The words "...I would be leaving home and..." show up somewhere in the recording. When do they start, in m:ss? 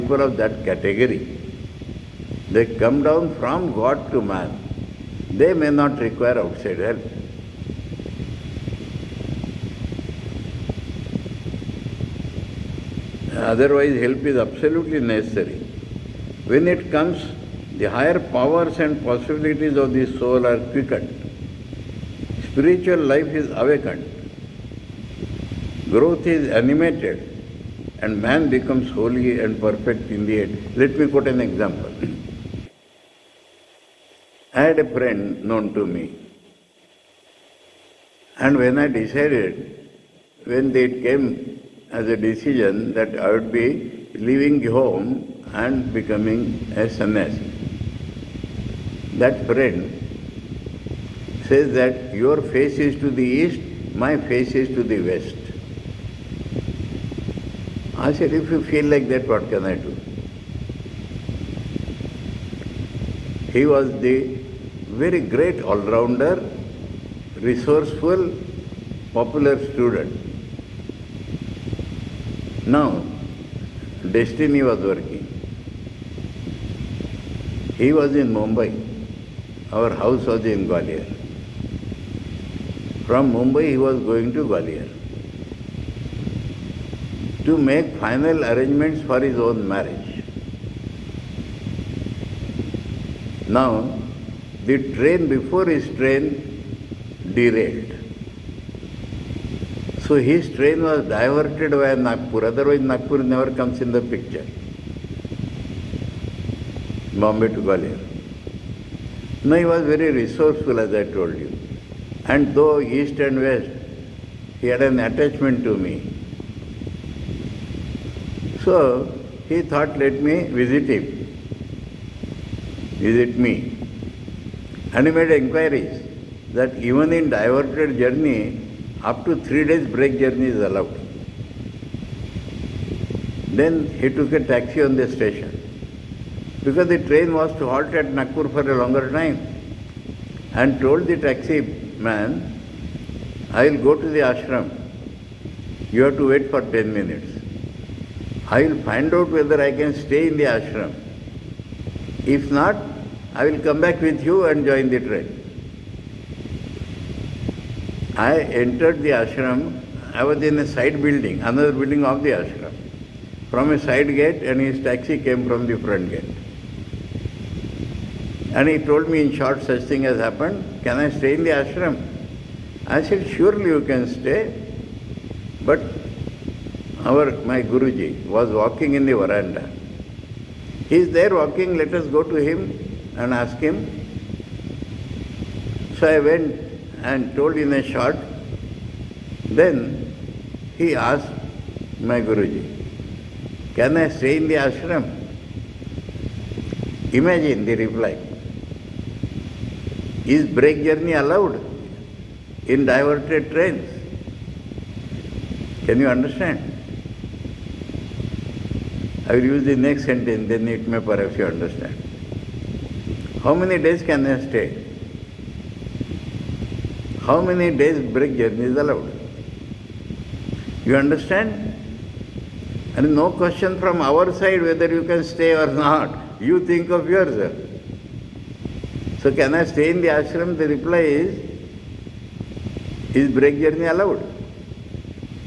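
0:43.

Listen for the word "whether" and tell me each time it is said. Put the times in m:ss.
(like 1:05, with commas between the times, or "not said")
2:29, 3:44.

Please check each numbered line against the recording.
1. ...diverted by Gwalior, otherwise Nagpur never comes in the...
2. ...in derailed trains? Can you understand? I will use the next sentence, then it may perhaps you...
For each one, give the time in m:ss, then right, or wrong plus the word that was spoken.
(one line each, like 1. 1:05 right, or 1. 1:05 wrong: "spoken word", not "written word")
1. 1:41 wrong: "Nagpur", not "Gwalior"
2. 3:22 wrong: "diverted", not "derailed".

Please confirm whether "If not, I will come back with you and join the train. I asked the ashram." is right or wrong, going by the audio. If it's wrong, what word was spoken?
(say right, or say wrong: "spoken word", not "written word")
wrong: "entered", not "asked".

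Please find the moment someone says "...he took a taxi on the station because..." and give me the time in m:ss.
2:13.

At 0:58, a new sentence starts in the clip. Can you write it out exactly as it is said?
I said, if you feel like that, what can I do?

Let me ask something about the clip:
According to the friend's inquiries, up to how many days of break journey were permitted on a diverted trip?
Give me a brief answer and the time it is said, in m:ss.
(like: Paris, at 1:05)
3 days, at 2:09.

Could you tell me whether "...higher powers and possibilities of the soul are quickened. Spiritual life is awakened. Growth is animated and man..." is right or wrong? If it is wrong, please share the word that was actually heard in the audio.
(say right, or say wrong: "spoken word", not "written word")
right.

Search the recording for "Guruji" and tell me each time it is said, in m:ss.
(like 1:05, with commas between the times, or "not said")
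2:57, 3:12.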